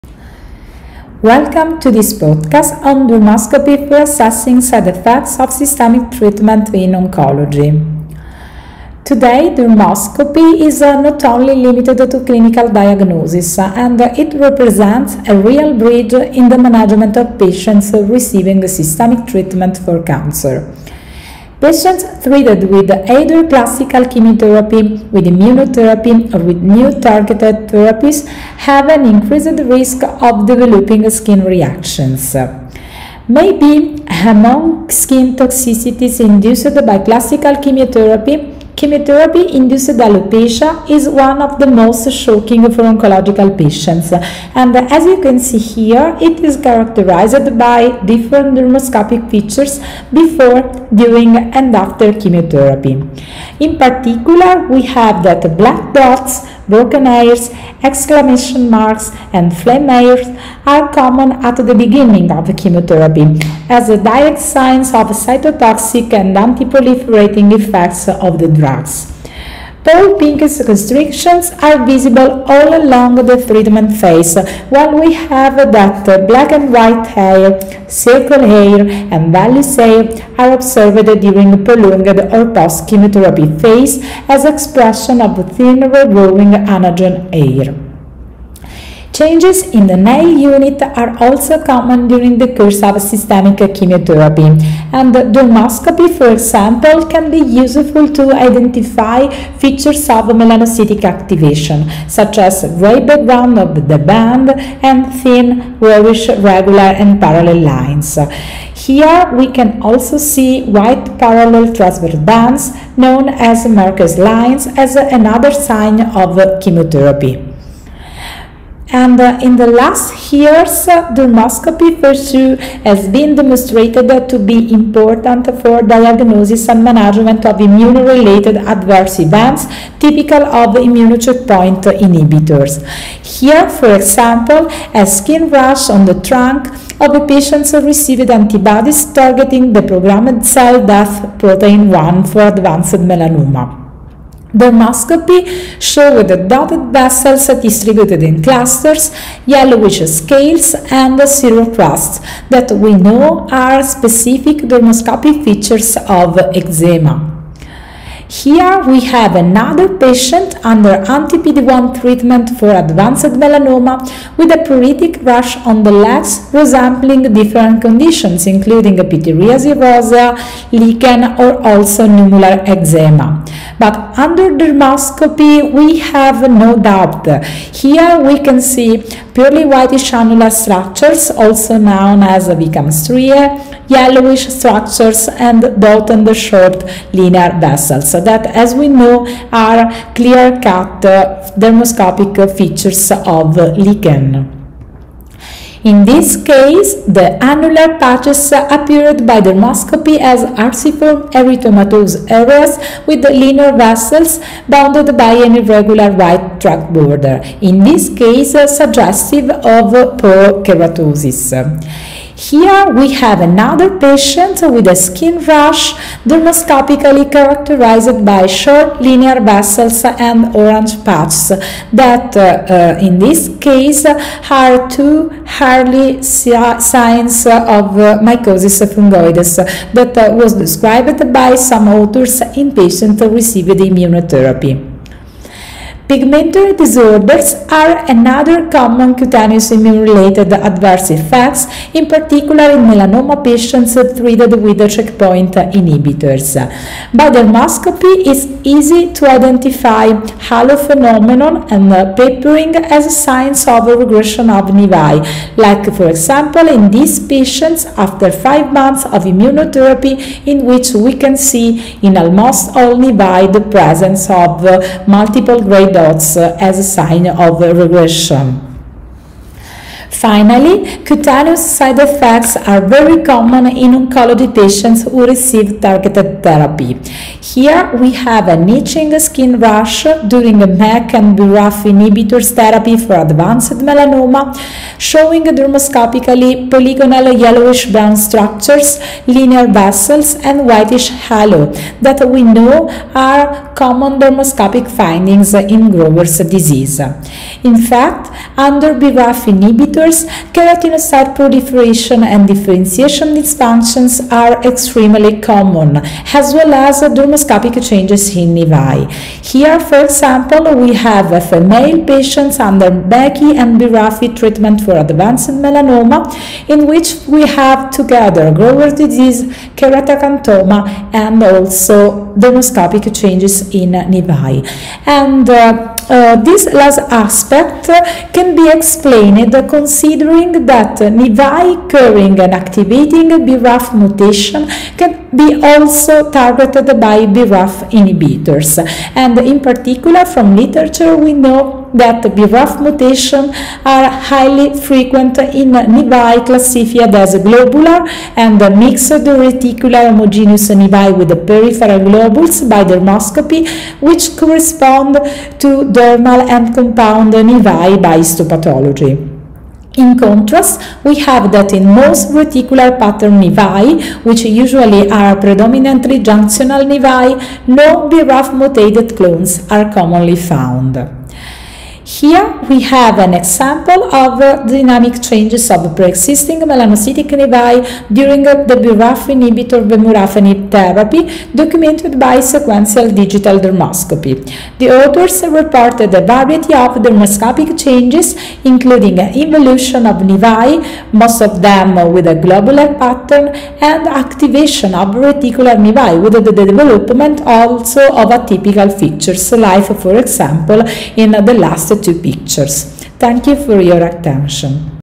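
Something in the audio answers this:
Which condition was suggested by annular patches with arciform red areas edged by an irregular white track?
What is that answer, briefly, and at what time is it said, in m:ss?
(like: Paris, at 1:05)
porokeratosis, at 3:30.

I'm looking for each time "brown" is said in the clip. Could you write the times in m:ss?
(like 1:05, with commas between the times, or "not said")
4:47.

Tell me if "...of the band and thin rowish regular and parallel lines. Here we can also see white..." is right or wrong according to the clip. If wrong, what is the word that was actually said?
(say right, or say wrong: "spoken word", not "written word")
right.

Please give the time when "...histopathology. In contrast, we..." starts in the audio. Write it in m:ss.
5:58.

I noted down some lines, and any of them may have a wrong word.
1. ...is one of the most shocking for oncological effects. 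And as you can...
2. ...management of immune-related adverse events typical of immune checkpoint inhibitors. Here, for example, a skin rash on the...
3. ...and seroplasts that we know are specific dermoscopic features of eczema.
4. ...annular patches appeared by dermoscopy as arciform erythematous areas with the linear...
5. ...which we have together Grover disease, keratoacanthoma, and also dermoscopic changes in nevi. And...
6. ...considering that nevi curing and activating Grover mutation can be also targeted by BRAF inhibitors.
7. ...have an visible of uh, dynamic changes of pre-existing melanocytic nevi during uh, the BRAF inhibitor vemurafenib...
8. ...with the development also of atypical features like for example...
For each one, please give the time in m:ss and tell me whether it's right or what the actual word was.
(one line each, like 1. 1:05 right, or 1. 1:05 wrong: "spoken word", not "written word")
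1. 0:40 wrong: "patients", not "effects"
2. 2:06 right
3. 2:30 right
4. 3:17 right
5. 5:16 right
6. 5:29 wrong: "BRAF", not "Grover"
7. 6:12 wrong: "example", not "visible"
8. 6:36 right.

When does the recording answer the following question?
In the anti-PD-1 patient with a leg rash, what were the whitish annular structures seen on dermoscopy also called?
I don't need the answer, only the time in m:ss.
3:03.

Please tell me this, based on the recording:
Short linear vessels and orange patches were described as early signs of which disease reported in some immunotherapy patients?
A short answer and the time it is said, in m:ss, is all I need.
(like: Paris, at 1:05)
mycosis fungoides, at 3:48.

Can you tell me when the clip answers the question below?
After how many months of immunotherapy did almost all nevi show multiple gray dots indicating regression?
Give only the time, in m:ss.
4:18.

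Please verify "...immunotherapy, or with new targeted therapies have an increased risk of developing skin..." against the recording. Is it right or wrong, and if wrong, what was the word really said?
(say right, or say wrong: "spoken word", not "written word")
right.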